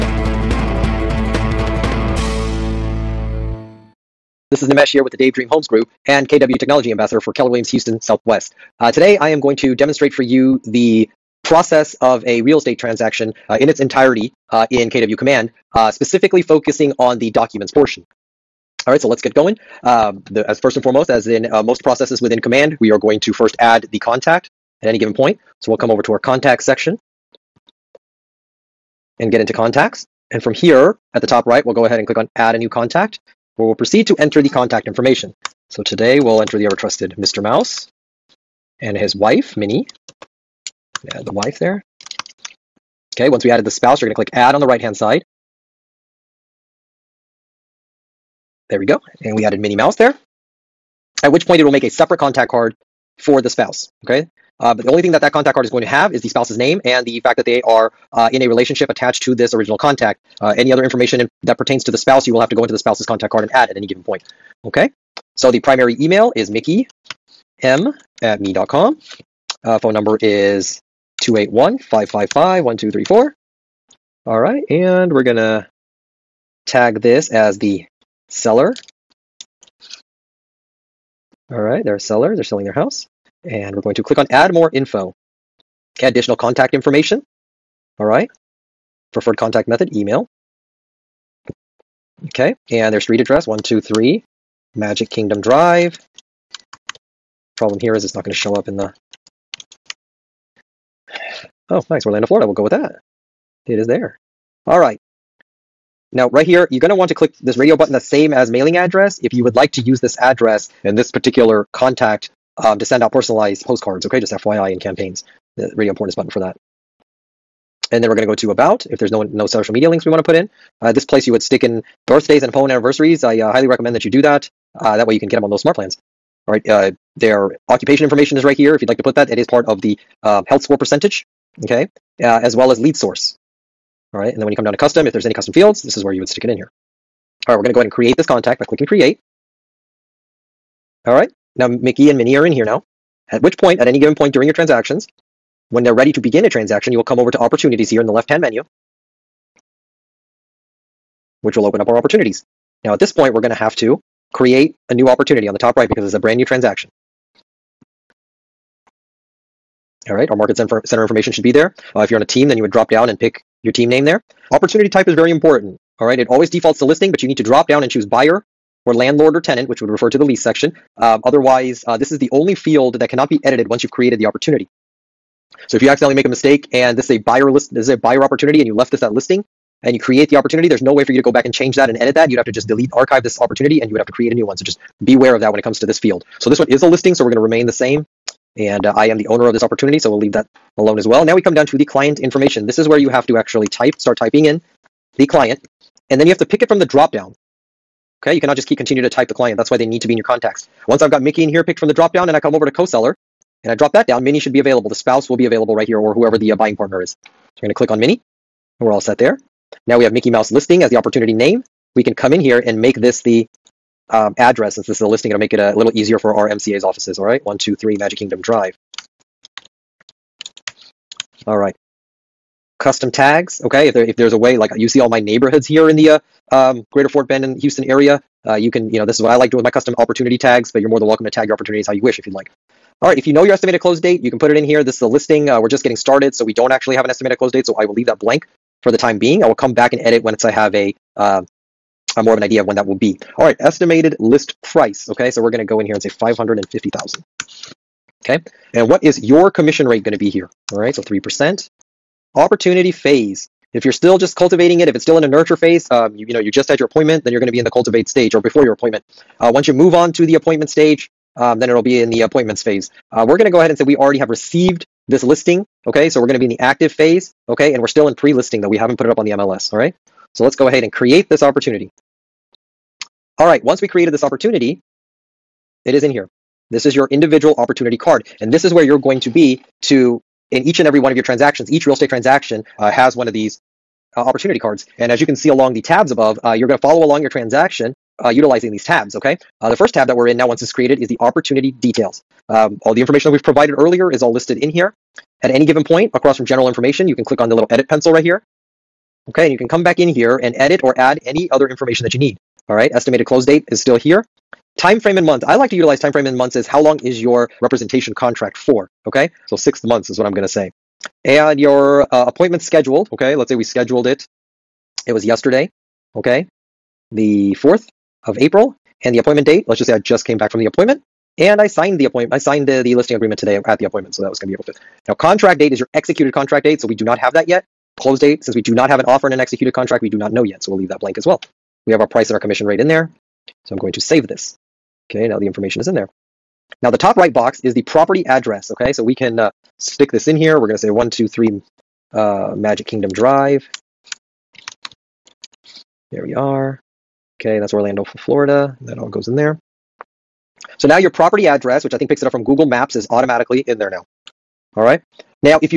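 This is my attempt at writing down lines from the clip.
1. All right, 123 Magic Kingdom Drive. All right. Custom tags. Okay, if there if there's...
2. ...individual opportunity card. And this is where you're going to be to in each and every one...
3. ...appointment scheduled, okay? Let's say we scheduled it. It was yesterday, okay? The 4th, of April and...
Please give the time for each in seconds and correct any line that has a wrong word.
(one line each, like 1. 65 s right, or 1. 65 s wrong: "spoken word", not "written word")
1. 217 s right
2. 277 s right
3. 312 s right.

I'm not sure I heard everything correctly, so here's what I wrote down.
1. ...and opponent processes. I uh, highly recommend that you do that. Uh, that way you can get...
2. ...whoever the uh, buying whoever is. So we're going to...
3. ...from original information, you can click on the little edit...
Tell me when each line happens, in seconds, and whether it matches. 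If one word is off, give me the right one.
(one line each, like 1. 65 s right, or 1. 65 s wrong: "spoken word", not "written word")
1. 122 s wrong: "anniversaries", not "processes"
2. 206 s wrong: "partner", not "whoever"
3. 296 s wrong: "general", not "original".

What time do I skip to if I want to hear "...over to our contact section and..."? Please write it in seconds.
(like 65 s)
25 s.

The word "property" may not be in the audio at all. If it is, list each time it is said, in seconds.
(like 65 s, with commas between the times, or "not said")
337 s, 351 s.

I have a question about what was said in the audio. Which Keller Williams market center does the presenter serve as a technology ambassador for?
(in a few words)
Houston Southwest.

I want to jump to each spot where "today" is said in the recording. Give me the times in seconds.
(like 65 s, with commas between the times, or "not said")
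8 s, 35 s, 323 s.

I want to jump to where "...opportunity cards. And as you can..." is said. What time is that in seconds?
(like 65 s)
284 s.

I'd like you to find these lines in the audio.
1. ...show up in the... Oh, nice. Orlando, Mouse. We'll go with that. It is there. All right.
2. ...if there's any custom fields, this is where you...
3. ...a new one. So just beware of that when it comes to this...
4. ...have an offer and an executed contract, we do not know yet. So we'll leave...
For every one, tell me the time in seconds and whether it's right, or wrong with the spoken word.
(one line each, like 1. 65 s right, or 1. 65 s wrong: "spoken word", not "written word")
1. 98 s wrong: "Florida", not "Mouse"
2. 135 s right
3. 184 s right
4. 328 s right.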